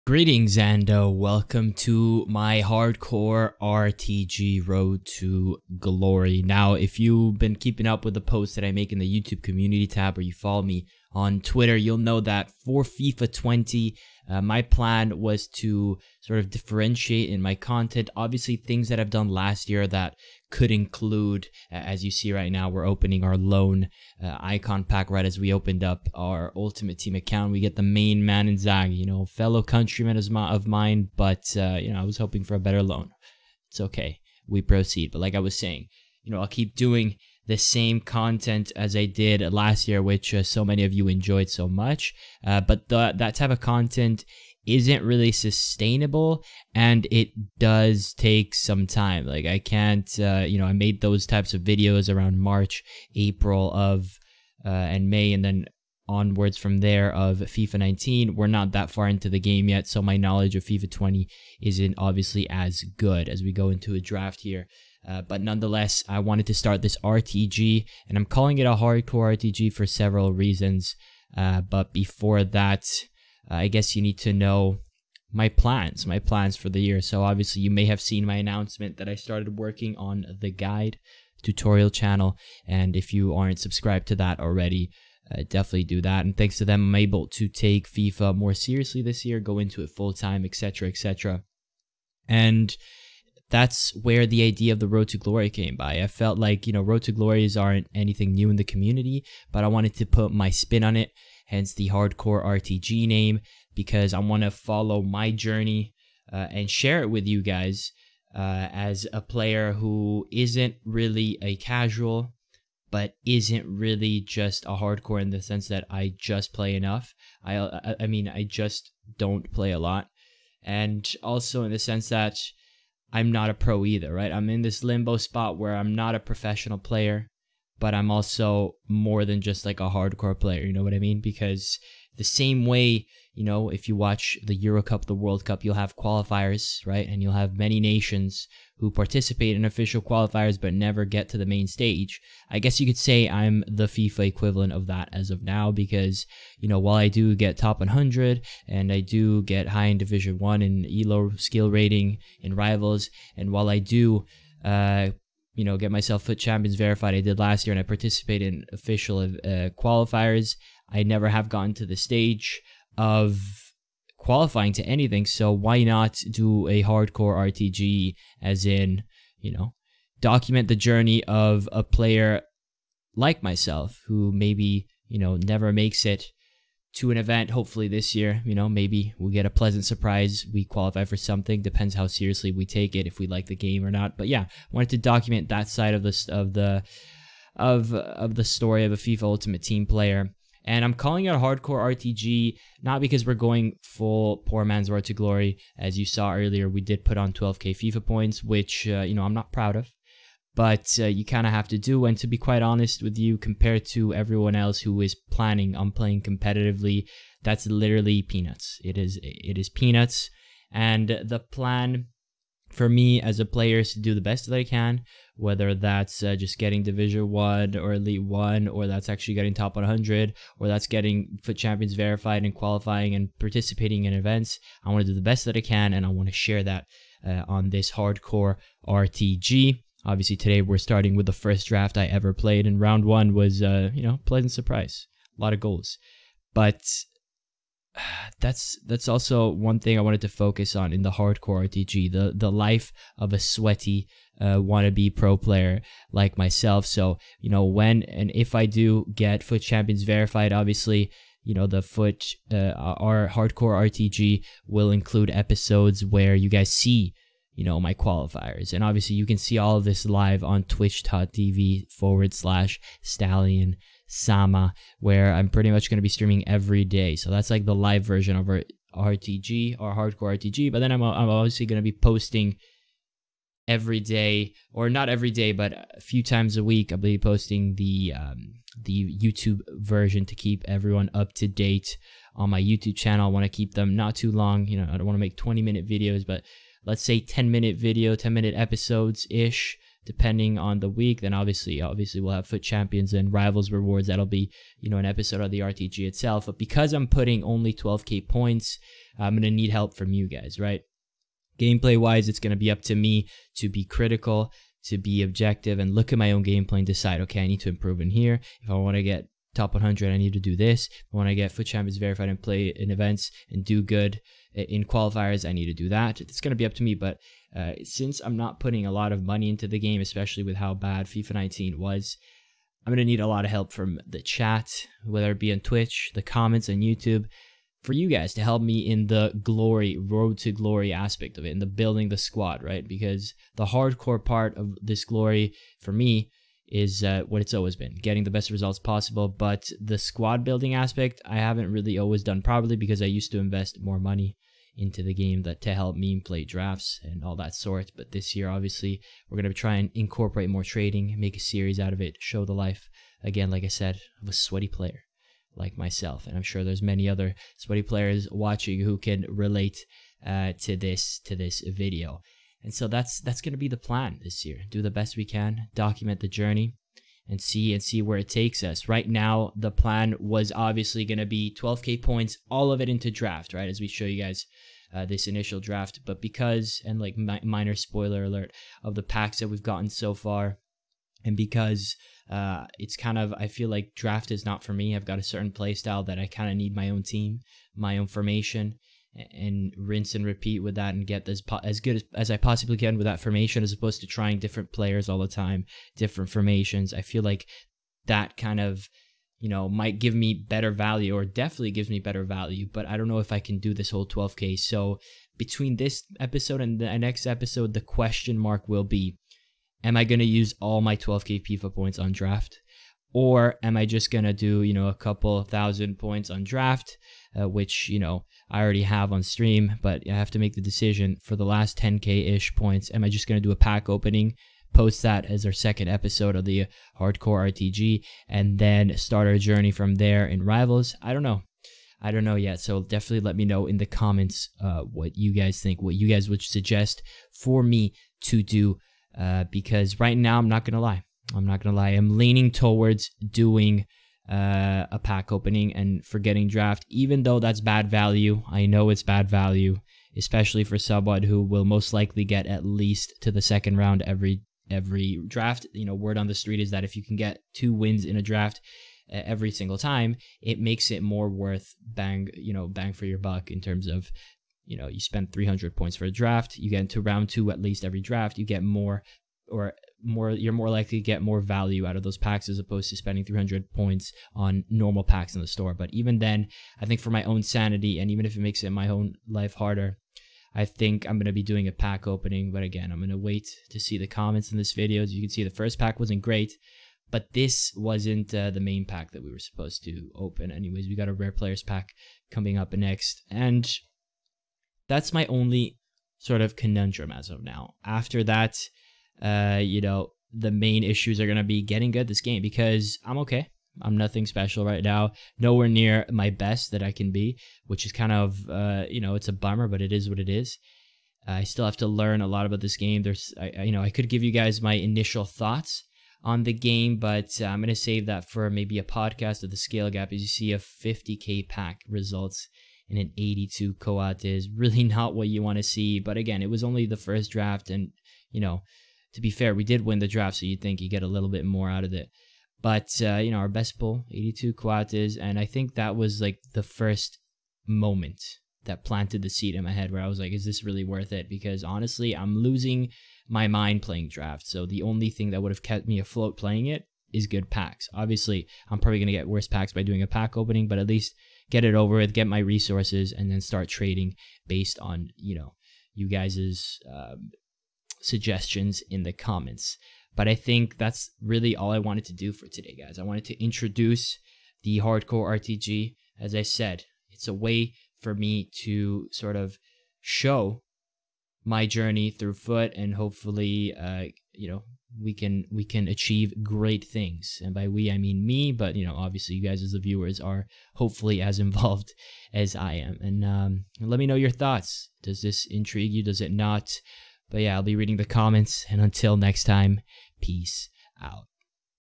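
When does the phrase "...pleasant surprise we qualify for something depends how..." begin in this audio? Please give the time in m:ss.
2:59.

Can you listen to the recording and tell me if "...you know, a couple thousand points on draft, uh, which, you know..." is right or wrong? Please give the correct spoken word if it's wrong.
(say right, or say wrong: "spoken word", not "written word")
right.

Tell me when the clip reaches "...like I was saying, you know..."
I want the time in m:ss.
0:35.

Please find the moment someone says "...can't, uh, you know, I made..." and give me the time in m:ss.
0:49.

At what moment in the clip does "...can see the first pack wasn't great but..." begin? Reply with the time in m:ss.
8:05.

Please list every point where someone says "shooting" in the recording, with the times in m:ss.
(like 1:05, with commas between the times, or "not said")
not said.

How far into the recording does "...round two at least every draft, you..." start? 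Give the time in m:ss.
7:47.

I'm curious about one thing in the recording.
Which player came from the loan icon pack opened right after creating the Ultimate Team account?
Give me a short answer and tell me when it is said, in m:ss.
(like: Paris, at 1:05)
Inzaghi, at 0:28.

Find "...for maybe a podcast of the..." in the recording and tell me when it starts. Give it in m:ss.
8:38.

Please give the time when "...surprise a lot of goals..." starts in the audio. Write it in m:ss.
3:54.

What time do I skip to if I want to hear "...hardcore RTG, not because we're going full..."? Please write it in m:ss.
3:11.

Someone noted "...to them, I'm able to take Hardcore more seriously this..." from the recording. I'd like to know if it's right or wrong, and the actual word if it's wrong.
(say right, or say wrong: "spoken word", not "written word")
wrong: "FIFA", not "Hardcore".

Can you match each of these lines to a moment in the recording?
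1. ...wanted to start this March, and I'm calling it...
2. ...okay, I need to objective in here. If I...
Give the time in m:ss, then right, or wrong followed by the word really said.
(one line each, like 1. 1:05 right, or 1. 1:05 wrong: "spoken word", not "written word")
1. 1:06 wrong: "RTG", not "March"
2. 5:07 wrong: "improve", not "objective".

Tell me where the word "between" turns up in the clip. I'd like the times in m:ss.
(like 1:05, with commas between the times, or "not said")
6:45.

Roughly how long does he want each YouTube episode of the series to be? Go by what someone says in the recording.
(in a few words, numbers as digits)
10 minutes.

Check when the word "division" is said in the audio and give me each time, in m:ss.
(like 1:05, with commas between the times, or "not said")
2:29, 3:36.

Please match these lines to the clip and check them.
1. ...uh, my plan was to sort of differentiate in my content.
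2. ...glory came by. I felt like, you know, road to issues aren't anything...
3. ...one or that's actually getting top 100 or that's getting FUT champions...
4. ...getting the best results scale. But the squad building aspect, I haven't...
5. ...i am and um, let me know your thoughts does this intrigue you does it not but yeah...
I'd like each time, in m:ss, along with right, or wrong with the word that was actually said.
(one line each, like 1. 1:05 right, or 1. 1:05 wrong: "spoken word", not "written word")
1. 0:14 right
2. 1:35 wrong: "glories", not "issues"
3. 3:38 right
4. 5:38 wrong: "possible", not "scale"
5. 9:42 right.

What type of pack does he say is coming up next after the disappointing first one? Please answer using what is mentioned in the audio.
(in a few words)
rare players pack.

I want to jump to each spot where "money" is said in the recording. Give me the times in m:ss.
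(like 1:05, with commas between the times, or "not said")
5:19, 5:43.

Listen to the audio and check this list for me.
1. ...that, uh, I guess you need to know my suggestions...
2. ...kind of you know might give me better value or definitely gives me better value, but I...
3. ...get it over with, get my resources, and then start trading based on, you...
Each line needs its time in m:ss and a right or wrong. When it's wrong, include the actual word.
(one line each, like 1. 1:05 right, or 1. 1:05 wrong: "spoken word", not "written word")
1. 1:12 wrong: "plans", not "suggestions"
2. 6:38 right
3. 9:11 right.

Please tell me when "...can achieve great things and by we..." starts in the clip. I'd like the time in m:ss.
9:35.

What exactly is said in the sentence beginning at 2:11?
Because the same way you know, if you watch the Euro Cup, the World Cup, you'll have qualifiers, right?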